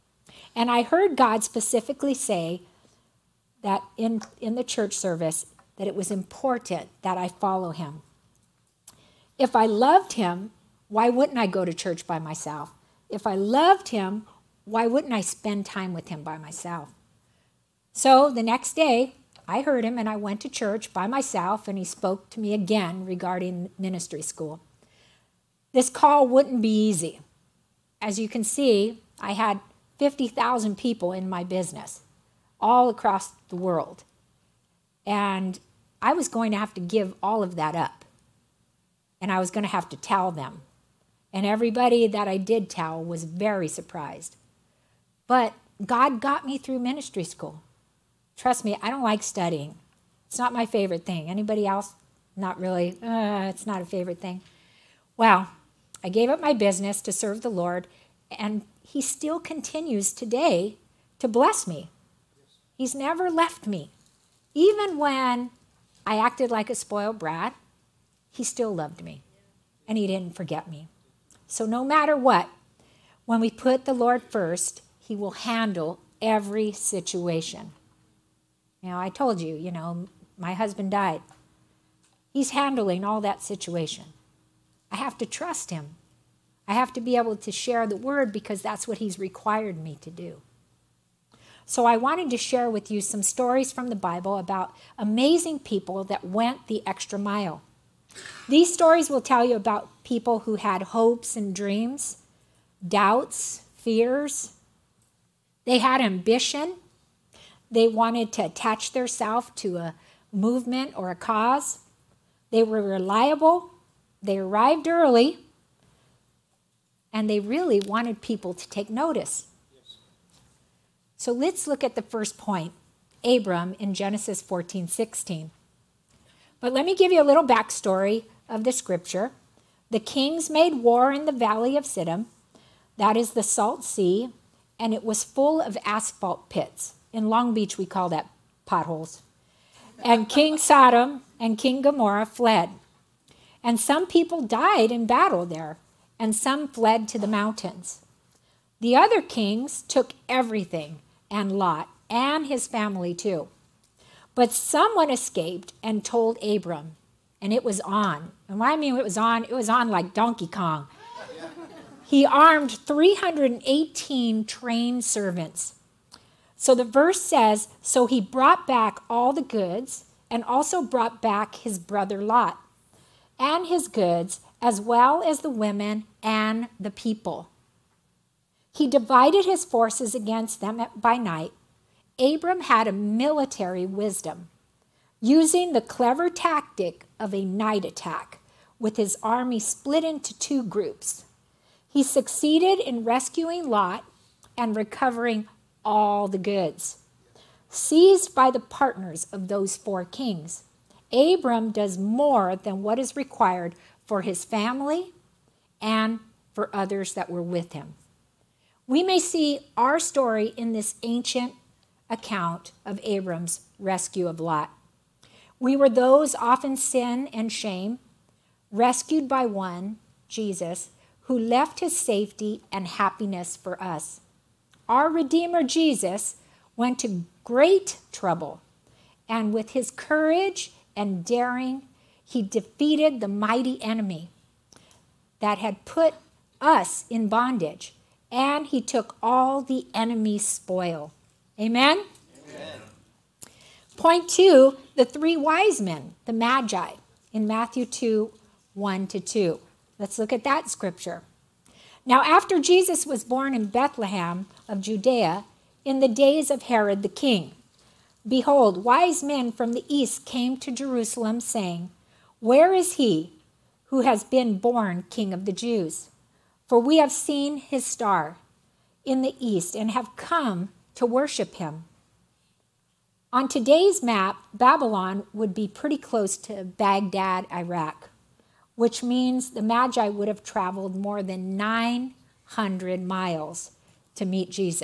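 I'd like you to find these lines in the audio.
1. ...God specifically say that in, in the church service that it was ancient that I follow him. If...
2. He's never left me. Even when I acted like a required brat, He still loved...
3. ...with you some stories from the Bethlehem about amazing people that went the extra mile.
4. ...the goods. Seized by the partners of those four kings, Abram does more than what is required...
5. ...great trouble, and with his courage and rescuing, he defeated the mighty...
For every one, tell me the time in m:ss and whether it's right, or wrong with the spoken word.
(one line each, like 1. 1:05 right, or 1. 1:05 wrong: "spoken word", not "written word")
1. 0:01 wrong: "important", not "ancient"
2. 1:02 wrong: "spoiled", not "required"
3. 1:32 wrong: "Bible", not "Bethlehem"
4. 3:16 right
5. 3:47 wrong: "daring", not "rescuing".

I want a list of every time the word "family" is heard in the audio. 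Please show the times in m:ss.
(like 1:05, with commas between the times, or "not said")
2:32, 3:24.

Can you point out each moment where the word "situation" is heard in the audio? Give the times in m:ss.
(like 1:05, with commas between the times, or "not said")
1:16, 1:23.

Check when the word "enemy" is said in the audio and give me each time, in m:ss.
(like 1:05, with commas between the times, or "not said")
3:53, 3:59.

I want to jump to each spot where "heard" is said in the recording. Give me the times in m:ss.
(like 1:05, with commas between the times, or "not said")
0:00, 0:19.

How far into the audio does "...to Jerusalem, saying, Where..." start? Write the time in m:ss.
4:20.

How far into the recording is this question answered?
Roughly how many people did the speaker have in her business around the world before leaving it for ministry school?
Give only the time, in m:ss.
0:29.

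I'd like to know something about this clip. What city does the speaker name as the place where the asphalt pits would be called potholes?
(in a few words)
Long Beach.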